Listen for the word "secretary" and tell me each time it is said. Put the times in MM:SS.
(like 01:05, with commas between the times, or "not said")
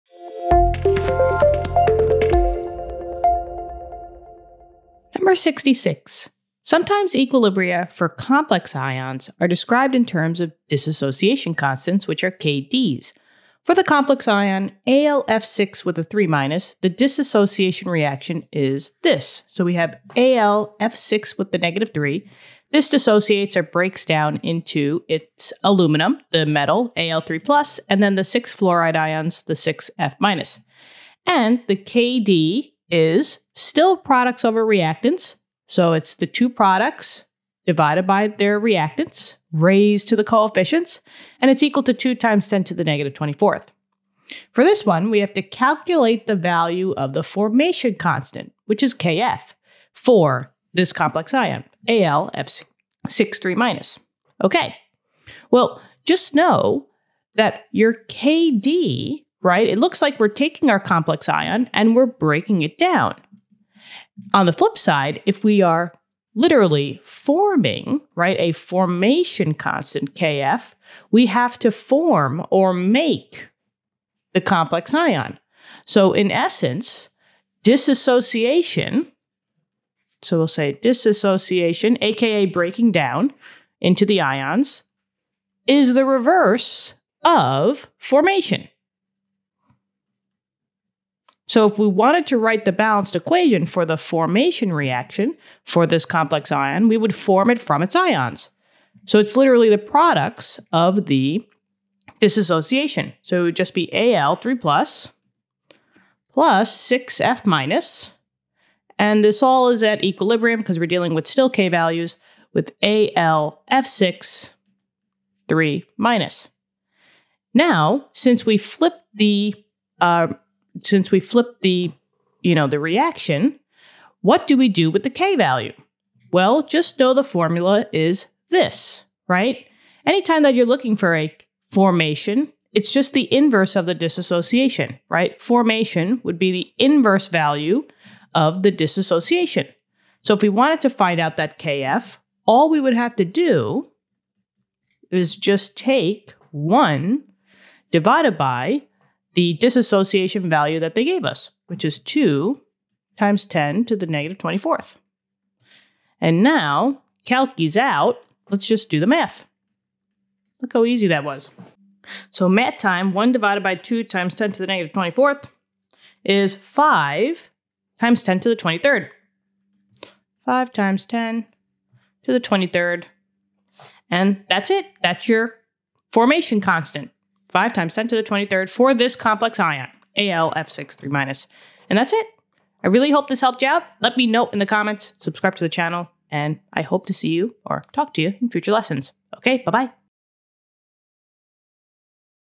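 not said.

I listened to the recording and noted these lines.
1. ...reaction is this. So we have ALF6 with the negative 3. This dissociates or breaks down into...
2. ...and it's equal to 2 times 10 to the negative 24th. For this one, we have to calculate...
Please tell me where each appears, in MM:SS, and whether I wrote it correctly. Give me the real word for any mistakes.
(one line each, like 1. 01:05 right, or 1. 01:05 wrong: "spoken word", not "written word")
1. 00:17 right
2. 00:41 right.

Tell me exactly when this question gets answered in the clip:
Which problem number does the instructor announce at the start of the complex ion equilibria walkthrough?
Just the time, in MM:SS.
00:05.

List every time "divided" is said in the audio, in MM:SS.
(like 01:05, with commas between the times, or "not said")
00:37, 02:27, 02:43.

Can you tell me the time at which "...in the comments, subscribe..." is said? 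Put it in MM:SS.
03:04.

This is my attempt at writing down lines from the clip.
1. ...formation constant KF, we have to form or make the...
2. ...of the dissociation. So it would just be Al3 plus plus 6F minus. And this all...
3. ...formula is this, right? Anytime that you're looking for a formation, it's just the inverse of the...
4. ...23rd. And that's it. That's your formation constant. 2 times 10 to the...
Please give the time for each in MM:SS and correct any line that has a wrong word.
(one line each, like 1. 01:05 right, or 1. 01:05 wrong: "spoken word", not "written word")
1. 01:08 right
2. 01:40 right
3. 02:07 right
4. 02:52 wrong: "5", not "2".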